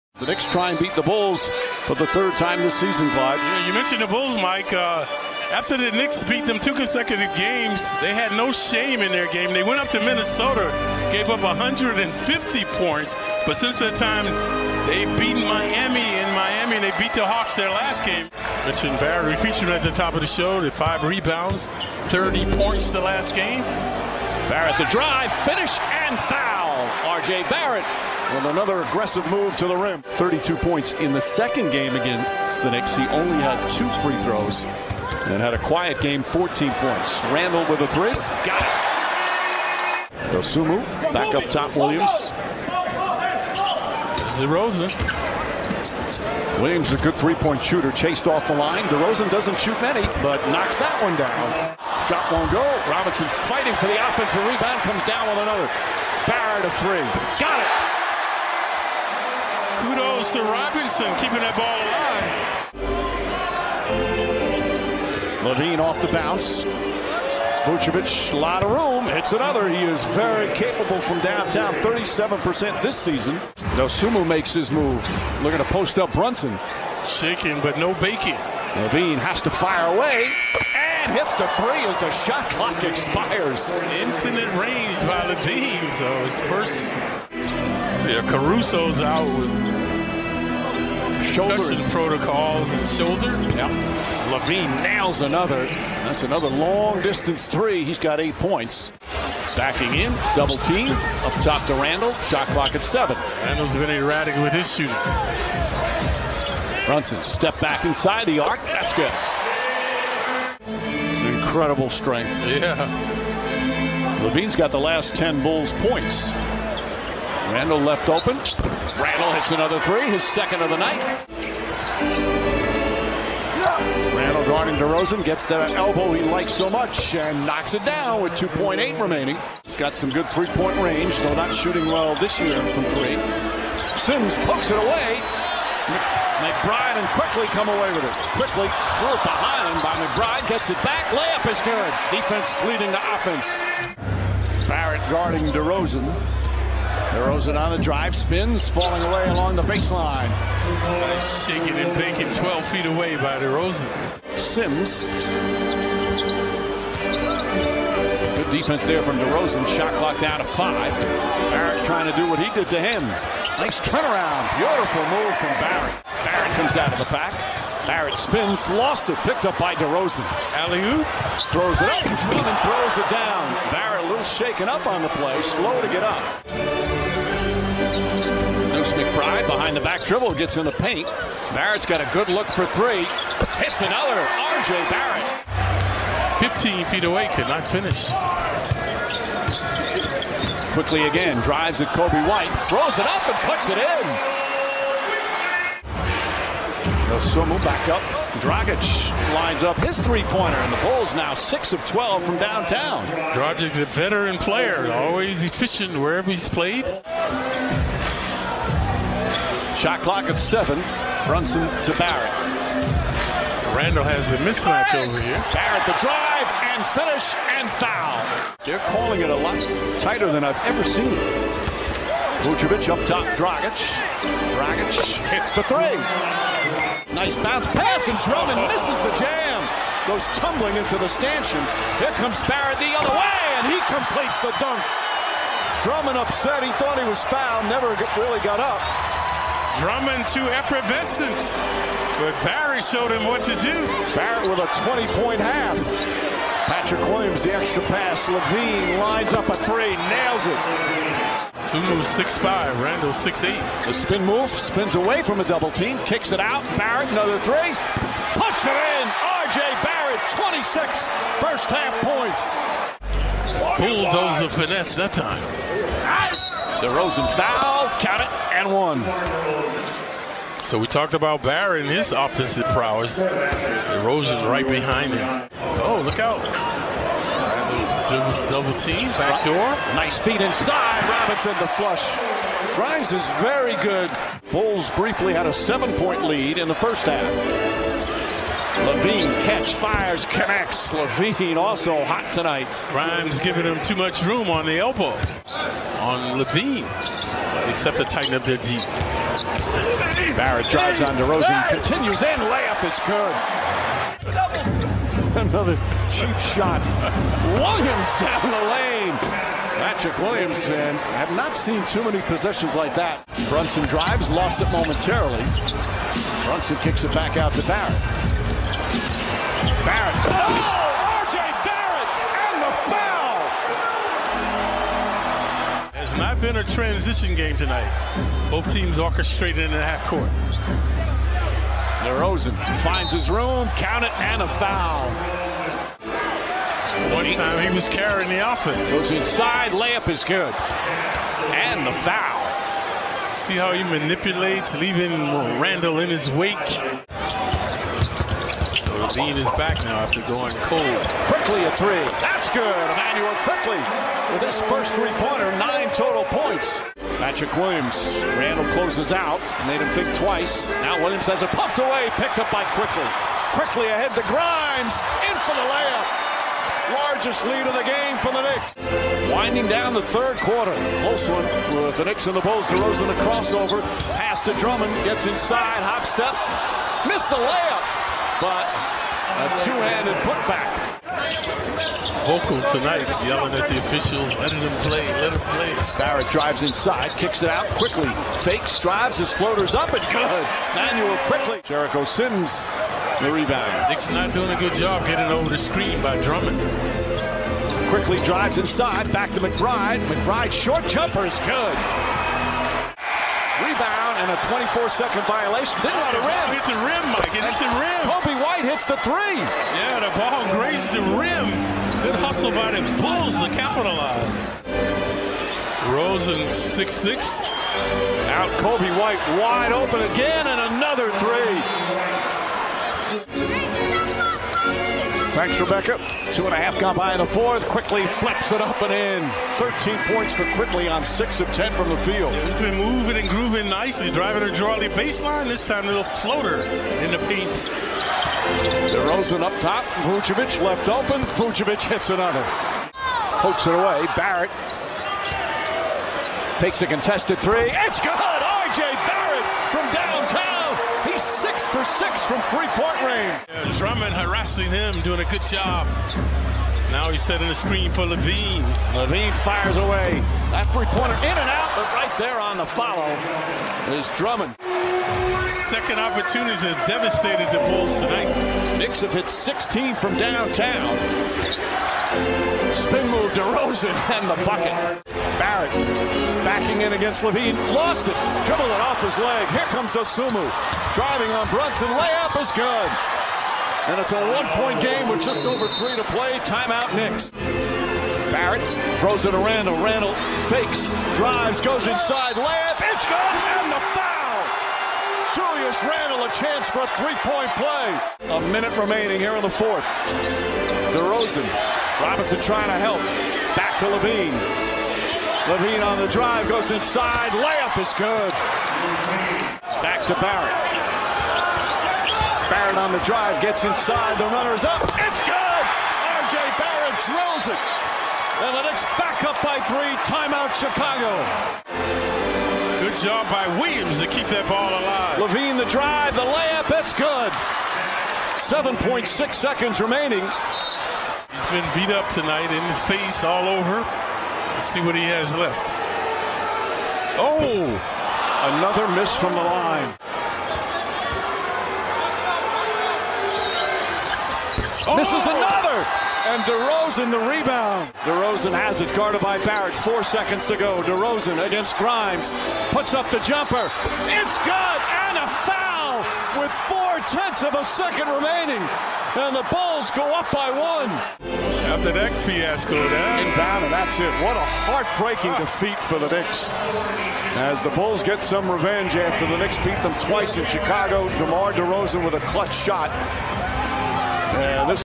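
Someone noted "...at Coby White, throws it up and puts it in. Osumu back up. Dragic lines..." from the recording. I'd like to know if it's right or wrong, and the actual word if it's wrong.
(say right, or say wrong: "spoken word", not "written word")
right.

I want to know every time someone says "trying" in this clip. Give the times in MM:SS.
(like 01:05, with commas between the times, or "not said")
02:41, 08:22.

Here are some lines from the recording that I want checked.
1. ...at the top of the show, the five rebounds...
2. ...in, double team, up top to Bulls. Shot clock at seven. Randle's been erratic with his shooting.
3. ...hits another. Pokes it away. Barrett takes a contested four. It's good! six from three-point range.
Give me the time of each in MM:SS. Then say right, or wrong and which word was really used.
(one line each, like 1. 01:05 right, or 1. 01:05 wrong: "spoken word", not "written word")
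1. 00:19 right
2. 01:39 wrong: "Randle", not "Bulls"
3. 07:21 wrong: "three", not "four".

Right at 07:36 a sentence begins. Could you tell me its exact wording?
Now he's setting the screen for LaVine.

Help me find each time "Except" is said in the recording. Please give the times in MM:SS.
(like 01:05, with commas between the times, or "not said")
04:57.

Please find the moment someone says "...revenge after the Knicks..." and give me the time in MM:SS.
09:28.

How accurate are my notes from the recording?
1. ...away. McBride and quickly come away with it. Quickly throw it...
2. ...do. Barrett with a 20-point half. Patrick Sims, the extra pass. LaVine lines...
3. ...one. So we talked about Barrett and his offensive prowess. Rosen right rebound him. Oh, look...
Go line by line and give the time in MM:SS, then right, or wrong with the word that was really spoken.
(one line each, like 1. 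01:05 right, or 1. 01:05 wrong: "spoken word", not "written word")
1. 02:14 right
2. 04:03 wrong: "Williams", not "Sims"
3. 04:28 wrong: "behind", not "rebound".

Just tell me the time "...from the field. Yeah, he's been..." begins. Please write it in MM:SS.
07:11.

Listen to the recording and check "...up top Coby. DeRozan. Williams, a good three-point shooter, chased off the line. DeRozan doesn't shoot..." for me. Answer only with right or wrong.
wrong.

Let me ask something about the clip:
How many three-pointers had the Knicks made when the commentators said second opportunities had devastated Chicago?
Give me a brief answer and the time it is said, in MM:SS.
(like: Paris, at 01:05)
16, at 07:49.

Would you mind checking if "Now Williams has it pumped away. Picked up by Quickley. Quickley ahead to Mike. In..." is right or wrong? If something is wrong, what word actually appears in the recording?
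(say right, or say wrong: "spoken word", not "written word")
wrong: "Grimes", not "Mike".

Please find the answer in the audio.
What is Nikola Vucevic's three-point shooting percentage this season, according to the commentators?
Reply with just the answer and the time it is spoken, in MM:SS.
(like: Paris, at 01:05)
37%, at 01:11.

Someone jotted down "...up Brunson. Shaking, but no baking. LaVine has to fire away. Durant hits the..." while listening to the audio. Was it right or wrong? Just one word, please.
right.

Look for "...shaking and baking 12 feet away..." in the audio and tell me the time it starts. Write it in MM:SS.
02:31.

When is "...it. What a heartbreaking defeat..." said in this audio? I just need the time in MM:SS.
09:23.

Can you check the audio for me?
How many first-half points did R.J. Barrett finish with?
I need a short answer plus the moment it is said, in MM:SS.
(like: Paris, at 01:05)
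26, at 04:20.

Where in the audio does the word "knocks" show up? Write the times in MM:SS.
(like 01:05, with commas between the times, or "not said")
00:50, 02:07.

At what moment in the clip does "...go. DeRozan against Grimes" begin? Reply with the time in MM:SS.
09:10.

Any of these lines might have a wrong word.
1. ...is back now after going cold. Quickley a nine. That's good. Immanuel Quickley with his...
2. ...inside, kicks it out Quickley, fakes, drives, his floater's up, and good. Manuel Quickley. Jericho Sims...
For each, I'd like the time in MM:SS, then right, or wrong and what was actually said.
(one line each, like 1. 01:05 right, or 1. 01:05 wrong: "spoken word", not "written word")
1. 05:49 wrong: "three", not "nine"
2. 06:26 right.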